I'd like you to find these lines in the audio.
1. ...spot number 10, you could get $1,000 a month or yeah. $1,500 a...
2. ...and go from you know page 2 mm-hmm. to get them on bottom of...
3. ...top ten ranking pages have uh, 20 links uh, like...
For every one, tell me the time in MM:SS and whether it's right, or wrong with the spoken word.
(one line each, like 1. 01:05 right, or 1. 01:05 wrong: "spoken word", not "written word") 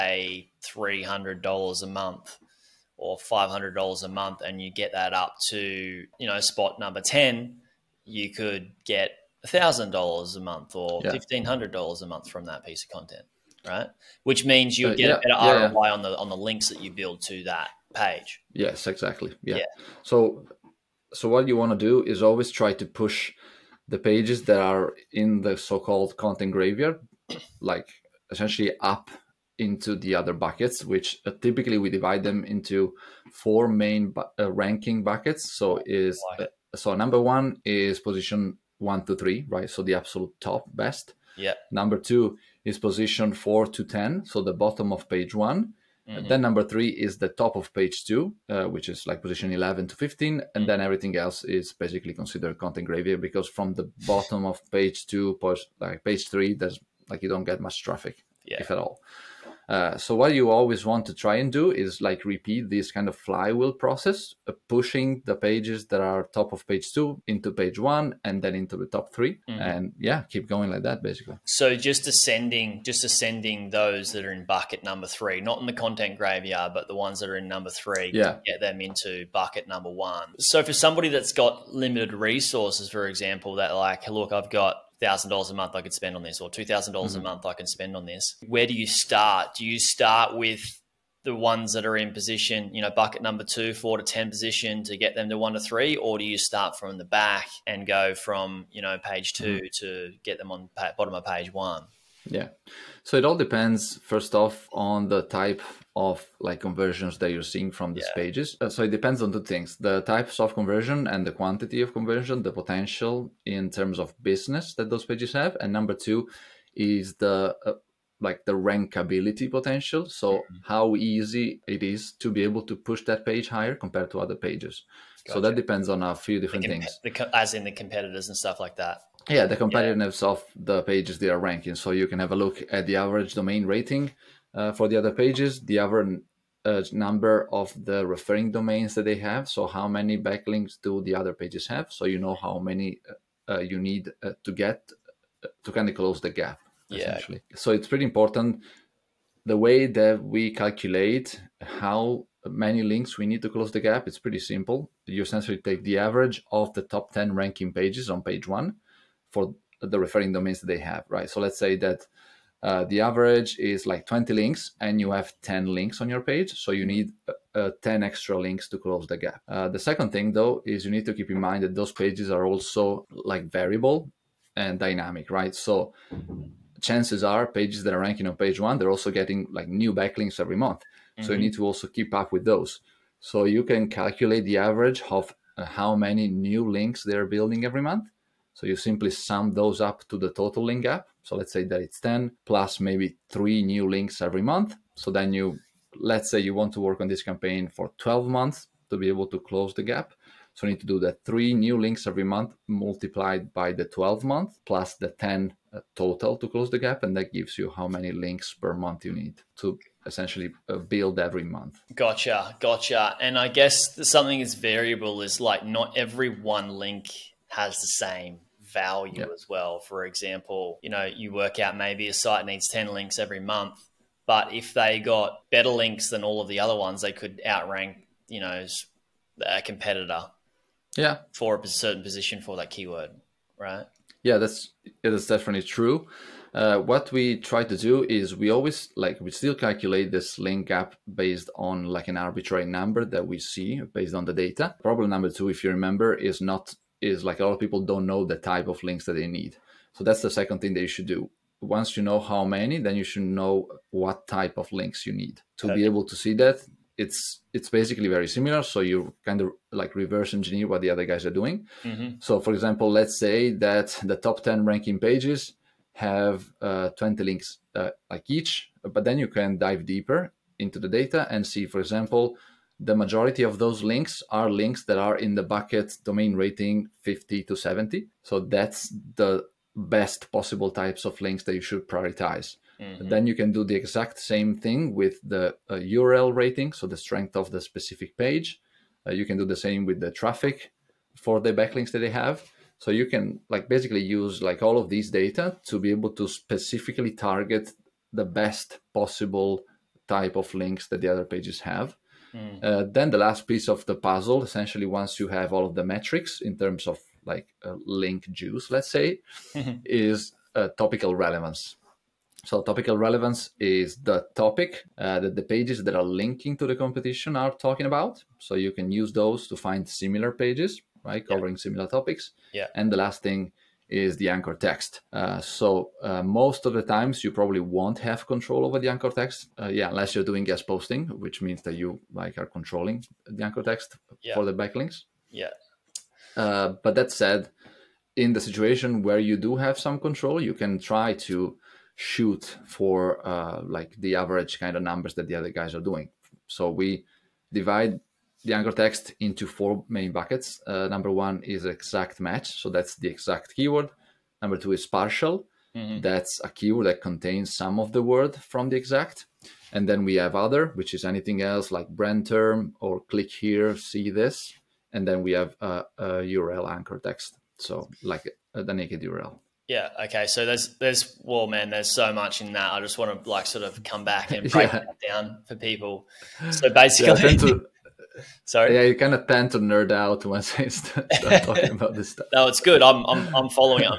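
1. 00:06 right
2. 01:37 right
3. 04:24 right.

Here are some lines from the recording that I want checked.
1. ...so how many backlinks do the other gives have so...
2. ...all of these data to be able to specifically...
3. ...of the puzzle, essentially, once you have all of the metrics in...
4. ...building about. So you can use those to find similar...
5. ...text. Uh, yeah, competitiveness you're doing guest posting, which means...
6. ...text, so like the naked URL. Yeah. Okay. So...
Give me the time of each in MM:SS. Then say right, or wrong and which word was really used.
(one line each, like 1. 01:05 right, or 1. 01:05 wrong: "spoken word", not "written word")
1. 02:19 wrong: "pages", not "gives"
2. 04:54 right
3. 05:03 right
4. 05:17 wrong: "talking", not "building"
5. 05:29 wrong: "unless", not "competitiveness"
6. 06:07 right.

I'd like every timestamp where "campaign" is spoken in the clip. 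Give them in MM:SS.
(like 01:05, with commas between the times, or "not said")
03:17.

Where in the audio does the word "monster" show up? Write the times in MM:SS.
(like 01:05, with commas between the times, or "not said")
not said.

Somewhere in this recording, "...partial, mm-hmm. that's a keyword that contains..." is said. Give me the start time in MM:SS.
05:54.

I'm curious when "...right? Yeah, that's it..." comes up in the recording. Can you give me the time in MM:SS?
03:53.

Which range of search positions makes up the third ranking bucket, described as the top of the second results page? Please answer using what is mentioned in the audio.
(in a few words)
11 to 15.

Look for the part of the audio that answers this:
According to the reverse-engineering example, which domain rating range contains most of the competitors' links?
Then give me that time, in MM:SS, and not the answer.
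04:36.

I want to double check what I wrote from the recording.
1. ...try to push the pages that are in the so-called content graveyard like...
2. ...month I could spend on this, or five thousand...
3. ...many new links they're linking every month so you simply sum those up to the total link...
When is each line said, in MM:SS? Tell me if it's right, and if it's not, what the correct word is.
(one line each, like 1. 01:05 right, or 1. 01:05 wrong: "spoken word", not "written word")
1. 00:22 right
2. 01:25 wrong: "two", not "five"
3. 03:05 wrong: "building", not "linking".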